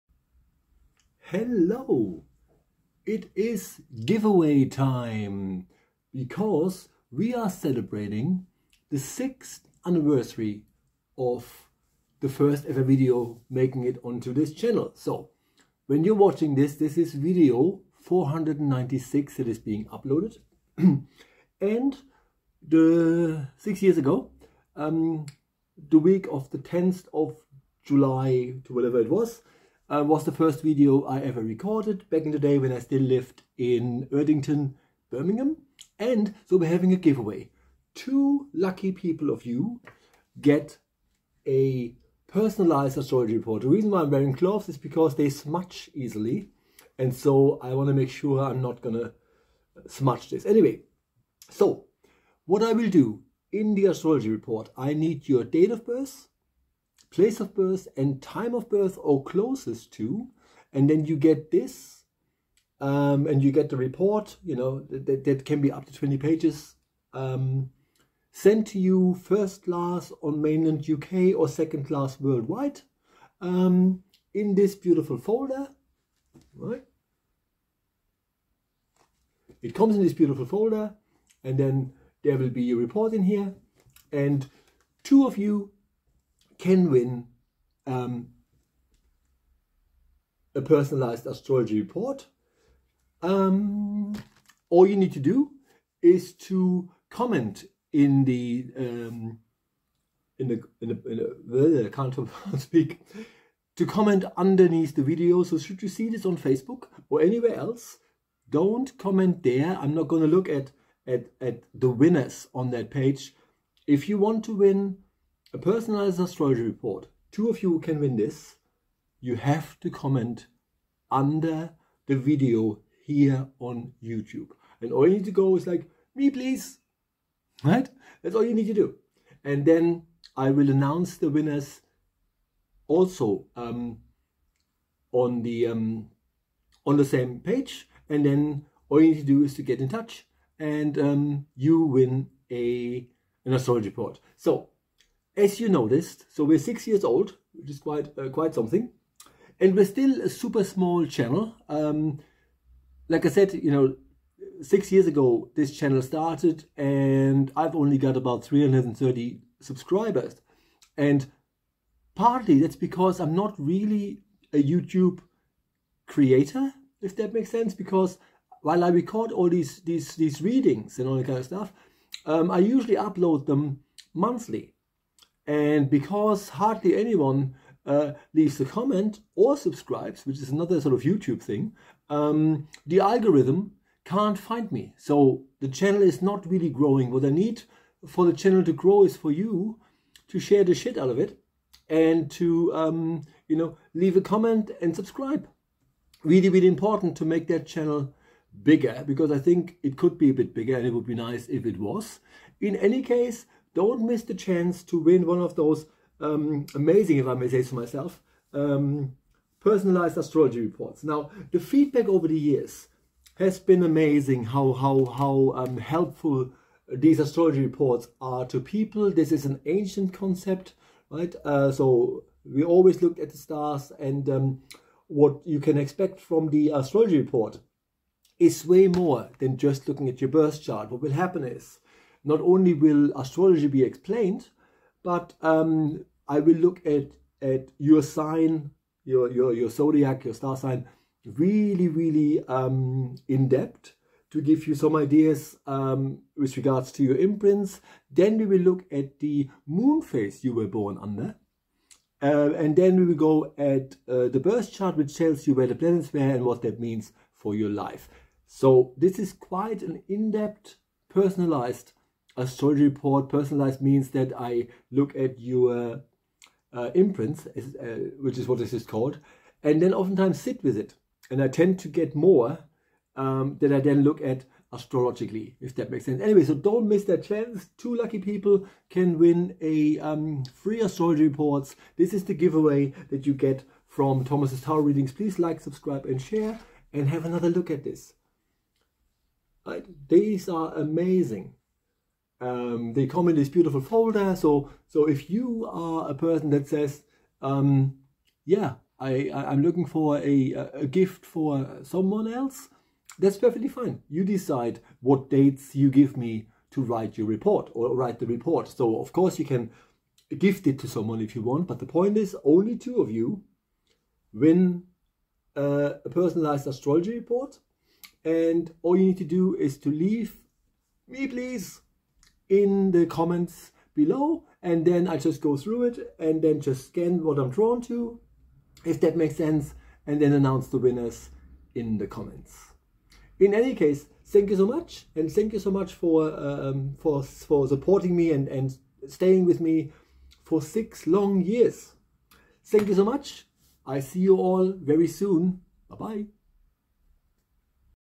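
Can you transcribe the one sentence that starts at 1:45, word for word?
So should you see this on Facebook or anywhere else, don't comment there.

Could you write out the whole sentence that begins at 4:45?
Please like, subscribe, and share, and have another look at this.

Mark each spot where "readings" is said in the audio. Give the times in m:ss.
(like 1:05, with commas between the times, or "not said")
2:50, 4:44.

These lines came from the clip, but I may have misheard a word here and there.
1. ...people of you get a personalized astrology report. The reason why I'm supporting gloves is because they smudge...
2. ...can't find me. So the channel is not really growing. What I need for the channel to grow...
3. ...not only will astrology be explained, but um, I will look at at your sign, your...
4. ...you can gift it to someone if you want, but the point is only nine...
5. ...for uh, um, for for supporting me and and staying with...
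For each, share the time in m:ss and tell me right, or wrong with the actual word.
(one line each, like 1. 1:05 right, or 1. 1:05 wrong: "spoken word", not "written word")
1. 0:38 wrong: "wearing", not "supporting"
2. 3:04 right
3. 3:52 right
4. 5:09 wrong: "two", not "nine"
5. 5:35 right.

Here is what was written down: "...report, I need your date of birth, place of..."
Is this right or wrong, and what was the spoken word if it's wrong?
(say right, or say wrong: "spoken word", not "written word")
right.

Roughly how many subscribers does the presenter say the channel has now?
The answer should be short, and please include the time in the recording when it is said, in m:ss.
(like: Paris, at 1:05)
330, at 2:38.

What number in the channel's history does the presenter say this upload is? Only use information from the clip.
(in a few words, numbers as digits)
496.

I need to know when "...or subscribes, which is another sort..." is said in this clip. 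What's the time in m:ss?
2:59.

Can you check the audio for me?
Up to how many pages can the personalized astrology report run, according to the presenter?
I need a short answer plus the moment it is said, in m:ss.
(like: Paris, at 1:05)
20, at 1:05.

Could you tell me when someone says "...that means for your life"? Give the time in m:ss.
4:16.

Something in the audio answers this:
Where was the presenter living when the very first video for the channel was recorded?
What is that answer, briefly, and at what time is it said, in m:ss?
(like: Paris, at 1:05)
Erdington, Birmingham, at 0:34.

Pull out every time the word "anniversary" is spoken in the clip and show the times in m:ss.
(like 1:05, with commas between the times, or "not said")
0:09.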